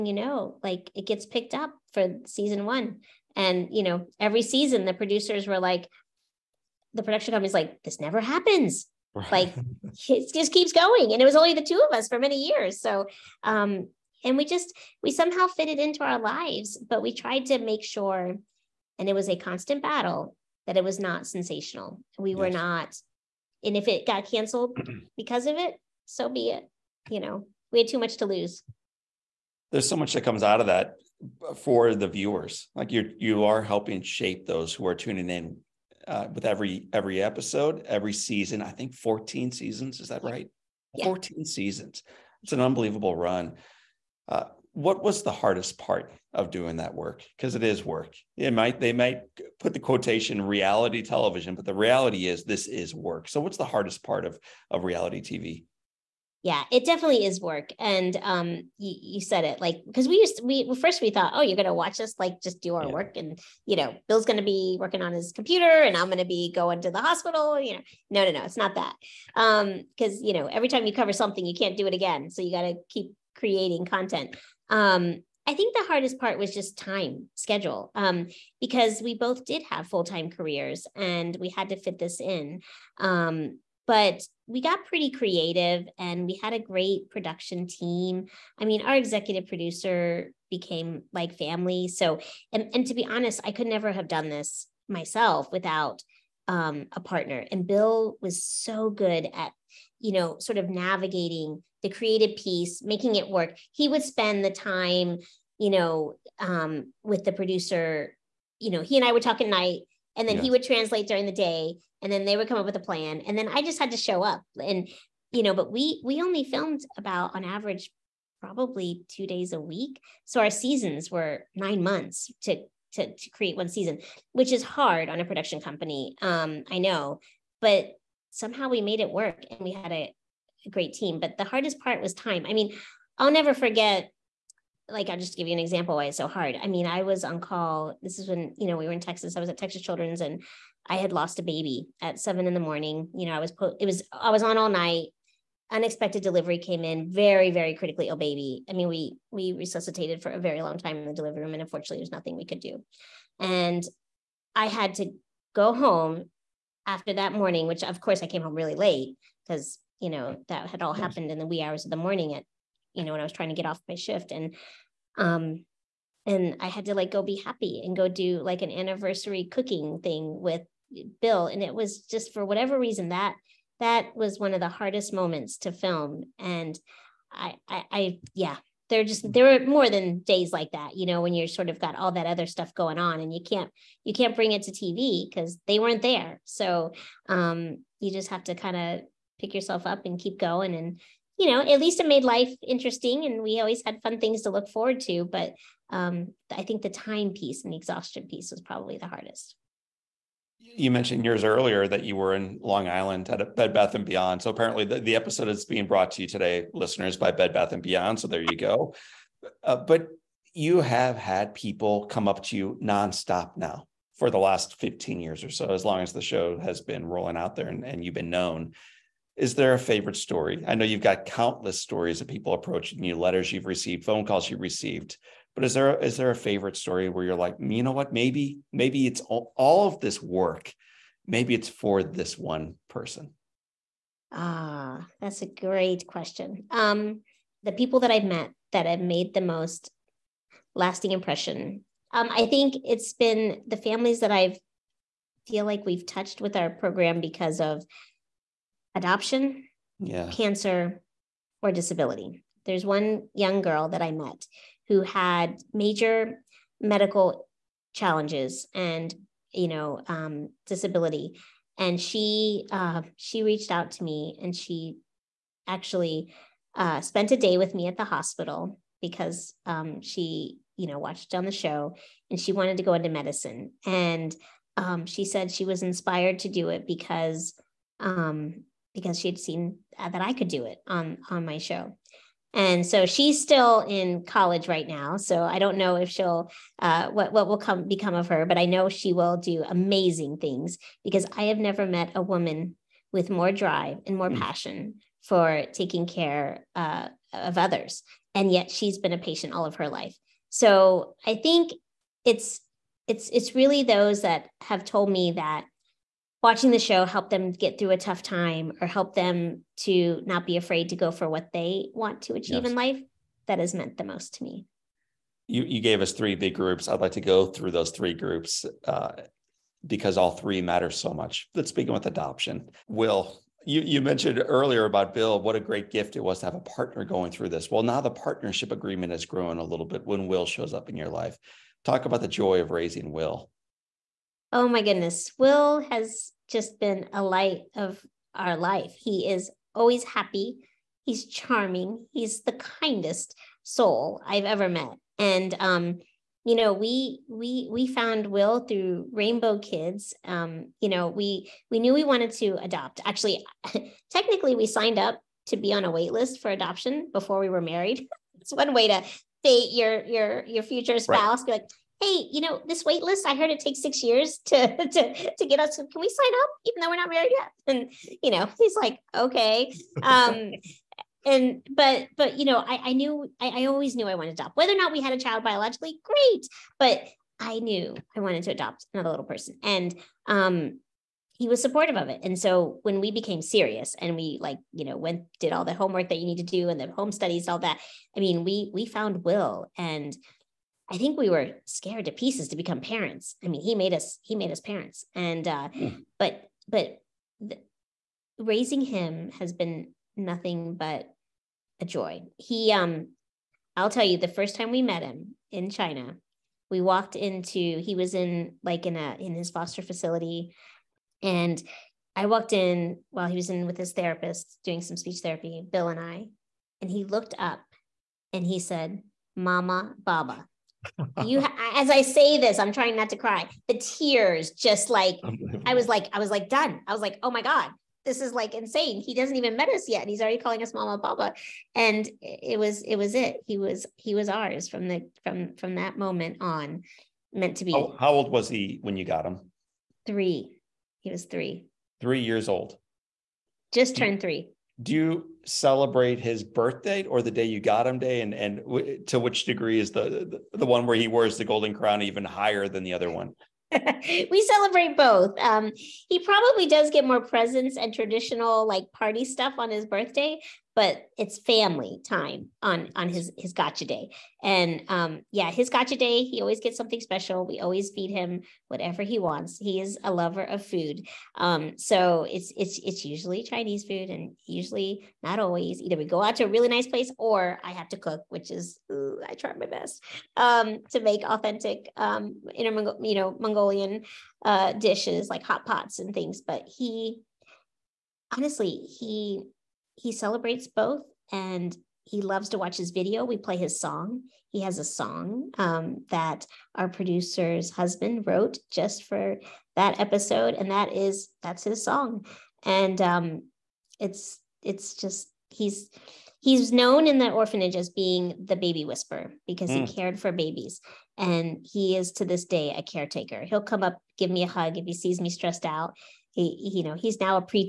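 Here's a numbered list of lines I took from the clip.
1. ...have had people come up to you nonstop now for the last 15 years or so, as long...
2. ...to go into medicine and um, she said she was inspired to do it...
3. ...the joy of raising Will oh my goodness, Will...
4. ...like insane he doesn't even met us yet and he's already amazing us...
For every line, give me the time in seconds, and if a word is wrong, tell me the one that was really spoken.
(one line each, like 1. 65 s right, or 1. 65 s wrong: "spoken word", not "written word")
1. 210 s right
2. 272 s right
3. 332 s right
4. 428 s wrong: "calling", not "amazing".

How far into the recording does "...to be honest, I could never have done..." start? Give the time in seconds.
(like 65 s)
92 s.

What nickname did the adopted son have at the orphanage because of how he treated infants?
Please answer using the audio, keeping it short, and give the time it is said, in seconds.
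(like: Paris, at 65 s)
baby whisperer, at 508 s.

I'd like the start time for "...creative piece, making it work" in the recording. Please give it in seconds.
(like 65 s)
101 s.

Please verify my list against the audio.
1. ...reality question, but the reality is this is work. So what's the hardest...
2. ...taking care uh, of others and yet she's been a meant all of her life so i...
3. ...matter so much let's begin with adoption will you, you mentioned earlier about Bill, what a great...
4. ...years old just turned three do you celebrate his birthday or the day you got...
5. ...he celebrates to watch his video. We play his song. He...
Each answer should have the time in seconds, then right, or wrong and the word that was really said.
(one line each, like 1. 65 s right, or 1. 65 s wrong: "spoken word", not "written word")
1. 50 s wrong: "television", not "question"
2. 295 s wrong: "patient", not "meant"
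3. 320 s right
4. 442 s right
5. 492 s wrong: "loves", not "celebrates".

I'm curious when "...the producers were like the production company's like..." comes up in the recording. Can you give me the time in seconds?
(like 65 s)
4 s.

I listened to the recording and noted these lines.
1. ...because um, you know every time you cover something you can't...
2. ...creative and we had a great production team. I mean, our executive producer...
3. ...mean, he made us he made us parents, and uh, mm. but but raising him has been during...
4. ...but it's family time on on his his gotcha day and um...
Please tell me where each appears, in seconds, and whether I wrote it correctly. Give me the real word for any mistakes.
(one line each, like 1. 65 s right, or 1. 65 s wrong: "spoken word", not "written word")
1. 69 s right
2. 85 s right
3. 393 s wrong: "nothing", not "during"
4. 460 s right.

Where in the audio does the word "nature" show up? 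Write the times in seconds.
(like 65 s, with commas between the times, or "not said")
not said.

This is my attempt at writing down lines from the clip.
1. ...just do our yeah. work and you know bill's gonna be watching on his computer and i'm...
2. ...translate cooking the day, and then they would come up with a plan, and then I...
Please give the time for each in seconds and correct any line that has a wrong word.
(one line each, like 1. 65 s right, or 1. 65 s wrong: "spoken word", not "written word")
1. 62 s wrong: "working", not "watching"
2. 110 s wrong: "during", not "cooking".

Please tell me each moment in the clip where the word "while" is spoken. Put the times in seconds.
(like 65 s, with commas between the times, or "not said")
413 s.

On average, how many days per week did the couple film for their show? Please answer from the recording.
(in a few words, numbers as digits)
2.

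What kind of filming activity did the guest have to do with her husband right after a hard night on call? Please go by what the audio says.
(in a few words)
anniversary cooking.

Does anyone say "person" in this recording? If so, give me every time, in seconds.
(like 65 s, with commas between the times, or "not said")
232 s, 379 s.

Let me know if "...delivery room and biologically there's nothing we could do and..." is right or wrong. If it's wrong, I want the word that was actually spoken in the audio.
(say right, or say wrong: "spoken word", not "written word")
wrong: "unfortunately", not "biologically".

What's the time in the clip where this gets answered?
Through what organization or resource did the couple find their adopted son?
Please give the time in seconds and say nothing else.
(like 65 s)
349 s.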